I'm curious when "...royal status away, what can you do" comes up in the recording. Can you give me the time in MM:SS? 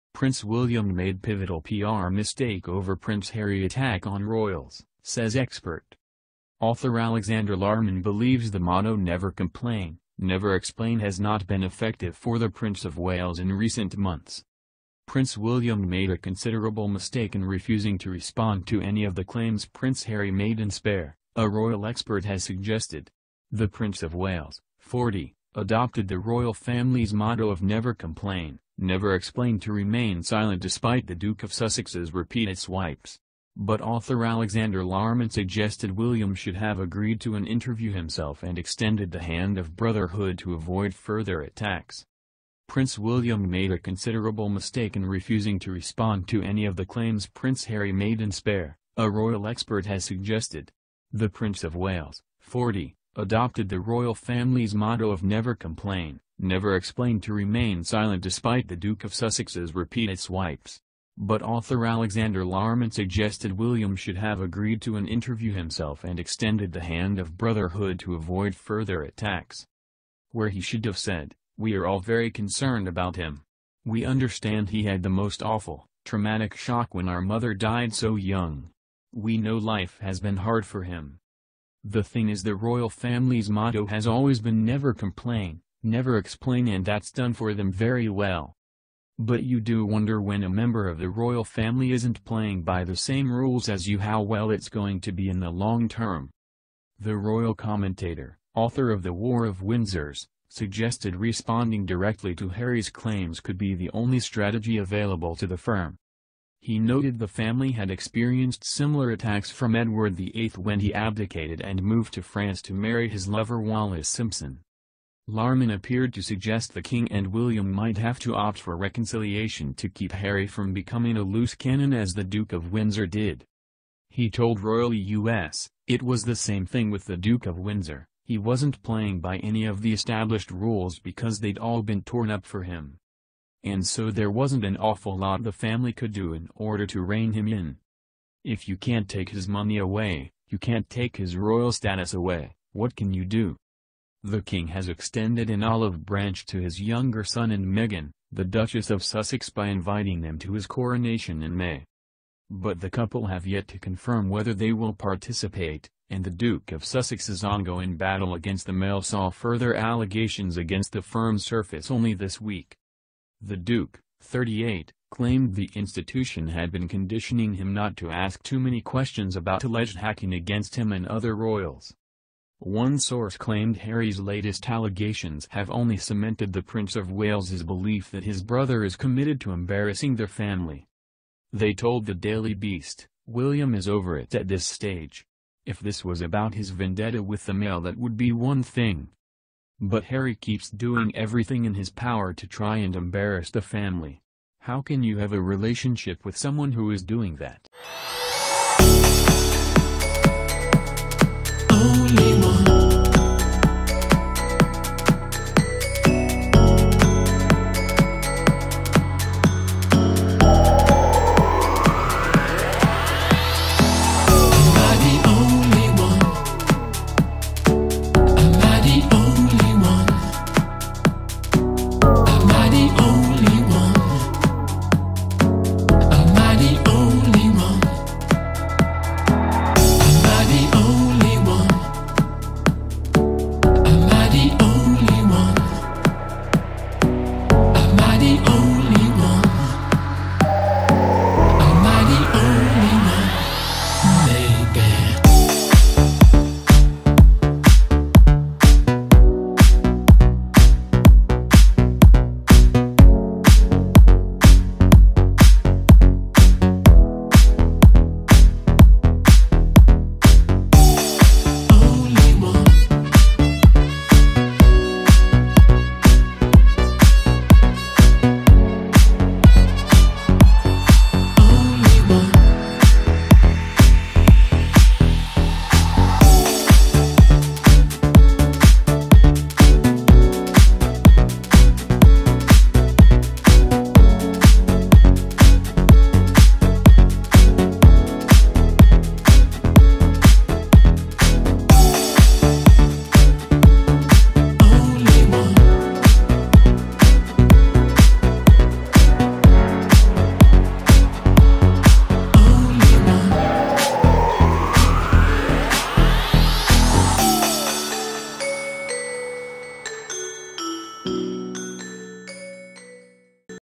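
02:21.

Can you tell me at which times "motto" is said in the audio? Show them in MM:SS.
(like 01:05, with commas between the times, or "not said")
00:08, 00:27, 00:54, 01:23.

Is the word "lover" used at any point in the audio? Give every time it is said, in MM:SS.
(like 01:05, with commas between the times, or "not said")
01:53.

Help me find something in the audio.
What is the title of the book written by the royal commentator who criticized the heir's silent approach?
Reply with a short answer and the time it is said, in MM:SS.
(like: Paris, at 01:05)
The War of Windsors, at 01:39.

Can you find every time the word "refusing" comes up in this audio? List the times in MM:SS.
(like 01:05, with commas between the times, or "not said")
00:17, 00:45.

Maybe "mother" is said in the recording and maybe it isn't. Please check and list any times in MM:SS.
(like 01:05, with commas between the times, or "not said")
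01:17.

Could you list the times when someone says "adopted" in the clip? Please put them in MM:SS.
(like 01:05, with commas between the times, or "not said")
00:25, 00:53.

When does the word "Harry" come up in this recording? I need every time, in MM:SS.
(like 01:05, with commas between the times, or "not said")
00:03, 00:20, 00:47, 01:42, 02:00, 02:53, 03:10.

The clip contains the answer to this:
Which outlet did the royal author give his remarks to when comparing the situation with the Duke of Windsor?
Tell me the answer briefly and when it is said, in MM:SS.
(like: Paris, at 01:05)
Royal U.S., at 02:04.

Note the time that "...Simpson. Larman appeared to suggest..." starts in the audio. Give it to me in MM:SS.
01:54.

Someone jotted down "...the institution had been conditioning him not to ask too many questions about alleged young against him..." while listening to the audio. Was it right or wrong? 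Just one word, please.
wrong.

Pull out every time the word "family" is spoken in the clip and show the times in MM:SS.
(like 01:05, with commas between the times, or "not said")
00:26, 00:54, 01:22, 01:31, 01:47, 02:15, 03:00, 03:13.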